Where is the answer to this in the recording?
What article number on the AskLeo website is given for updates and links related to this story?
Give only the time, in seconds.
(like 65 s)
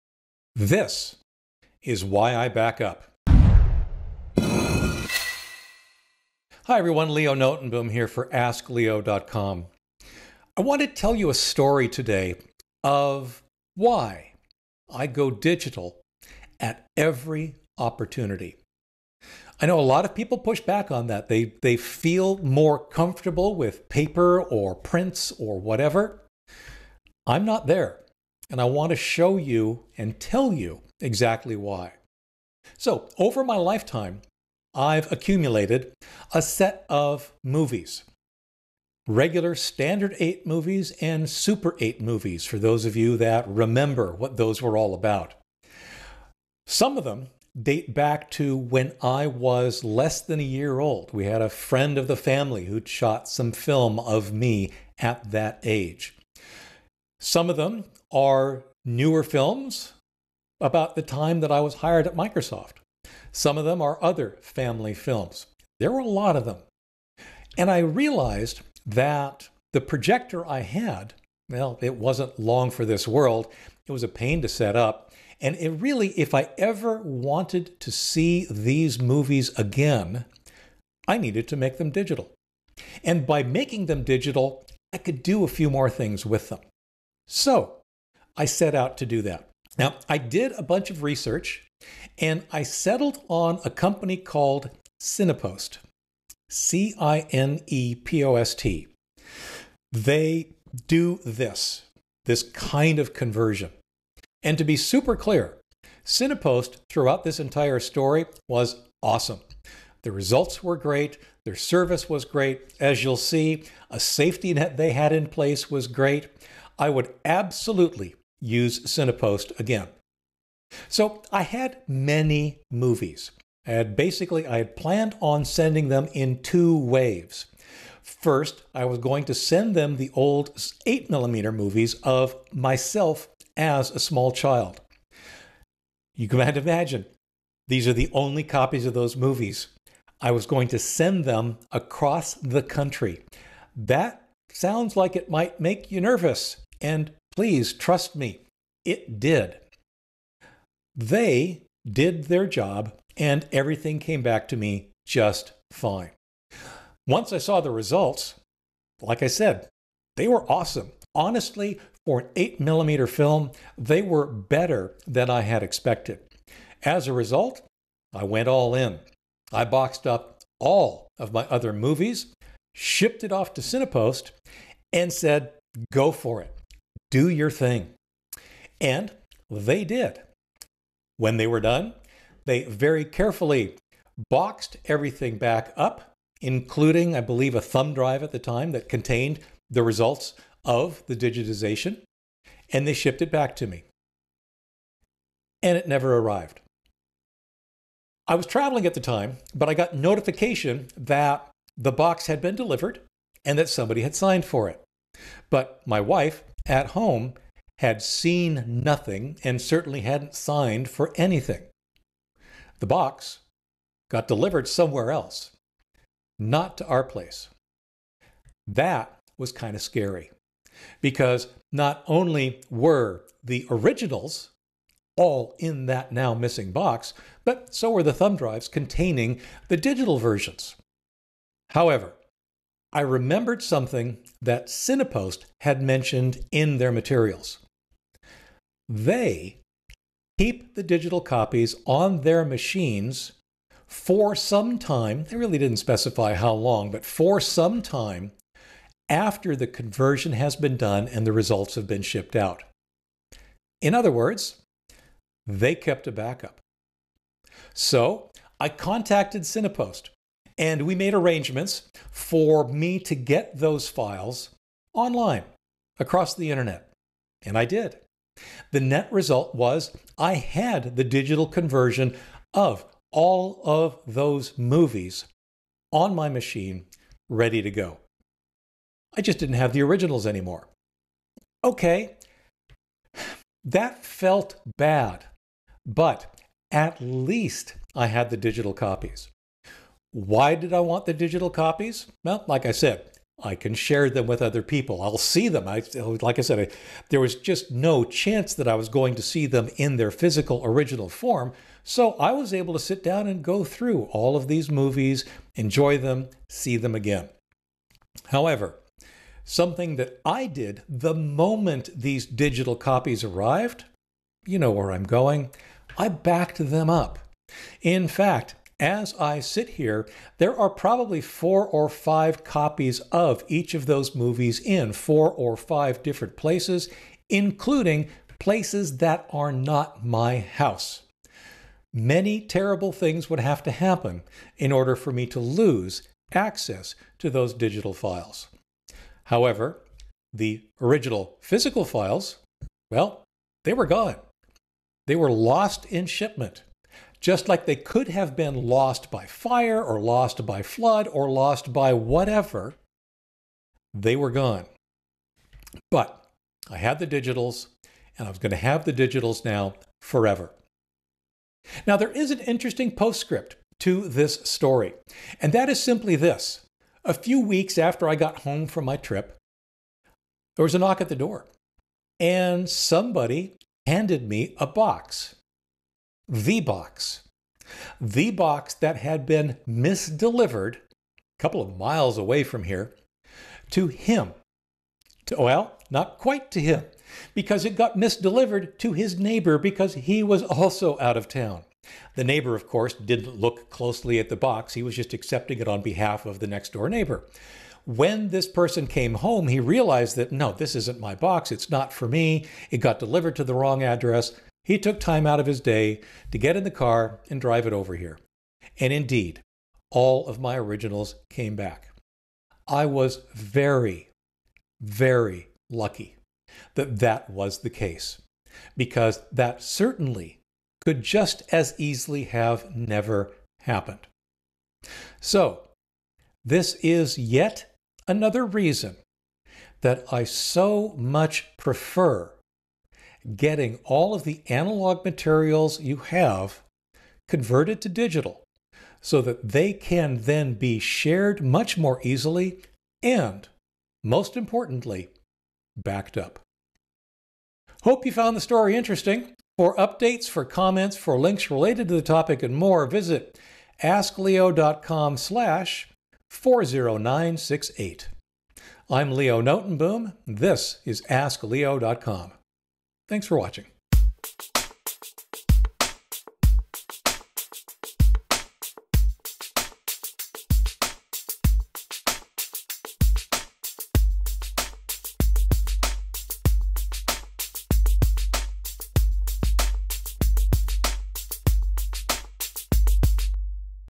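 456 s.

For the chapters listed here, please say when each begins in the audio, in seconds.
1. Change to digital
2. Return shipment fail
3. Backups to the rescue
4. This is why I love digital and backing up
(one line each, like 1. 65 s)
1. 60 s
2. 180 s
3. 240 s
4. 290 s.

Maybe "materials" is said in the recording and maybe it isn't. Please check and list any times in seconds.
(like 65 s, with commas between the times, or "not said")
236 s, 435 s.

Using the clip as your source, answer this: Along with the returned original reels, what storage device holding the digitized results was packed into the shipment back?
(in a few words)
A thumb drive.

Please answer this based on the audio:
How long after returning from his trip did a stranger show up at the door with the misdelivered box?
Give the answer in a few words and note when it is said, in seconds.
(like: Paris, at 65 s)
A few weeks, at 367 s.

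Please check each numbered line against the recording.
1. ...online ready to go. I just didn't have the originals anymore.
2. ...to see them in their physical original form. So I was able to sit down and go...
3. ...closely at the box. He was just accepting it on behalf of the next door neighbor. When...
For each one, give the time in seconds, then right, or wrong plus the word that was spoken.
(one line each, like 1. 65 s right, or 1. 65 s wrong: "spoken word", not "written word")
1. 276 s wrong: "machine", not "online"
2. 299 s right
3. 393 s right.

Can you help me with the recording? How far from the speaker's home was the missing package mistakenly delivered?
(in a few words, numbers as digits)
A couple of miles.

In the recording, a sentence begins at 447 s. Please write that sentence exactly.
Hope you found the story interesting.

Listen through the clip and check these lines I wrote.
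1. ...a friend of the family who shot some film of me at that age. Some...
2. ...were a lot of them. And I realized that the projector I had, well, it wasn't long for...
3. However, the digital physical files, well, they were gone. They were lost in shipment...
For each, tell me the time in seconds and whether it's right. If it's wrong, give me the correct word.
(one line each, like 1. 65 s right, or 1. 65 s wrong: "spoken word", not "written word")
1. 51 s right
2. 65 s right
3. 339 s wrong: "original", not "digital".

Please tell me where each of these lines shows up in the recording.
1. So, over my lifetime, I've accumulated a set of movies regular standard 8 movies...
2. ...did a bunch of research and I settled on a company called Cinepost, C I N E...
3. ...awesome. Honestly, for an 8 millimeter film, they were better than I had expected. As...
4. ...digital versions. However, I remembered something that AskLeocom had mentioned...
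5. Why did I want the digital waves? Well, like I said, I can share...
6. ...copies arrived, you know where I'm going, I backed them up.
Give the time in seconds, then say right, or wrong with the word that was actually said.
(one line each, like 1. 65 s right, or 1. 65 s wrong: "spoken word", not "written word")
1. 32 s right
2. 90 s right
3. 160 s right
4. 229 s wrong: "Cinepost", not "AskLeocom"
5. 290 s wrong: "copies", not "waves"
6. 312 s right.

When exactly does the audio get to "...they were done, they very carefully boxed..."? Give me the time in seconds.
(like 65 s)
181 s.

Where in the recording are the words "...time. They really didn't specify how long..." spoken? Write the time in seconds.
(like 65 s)
244 s.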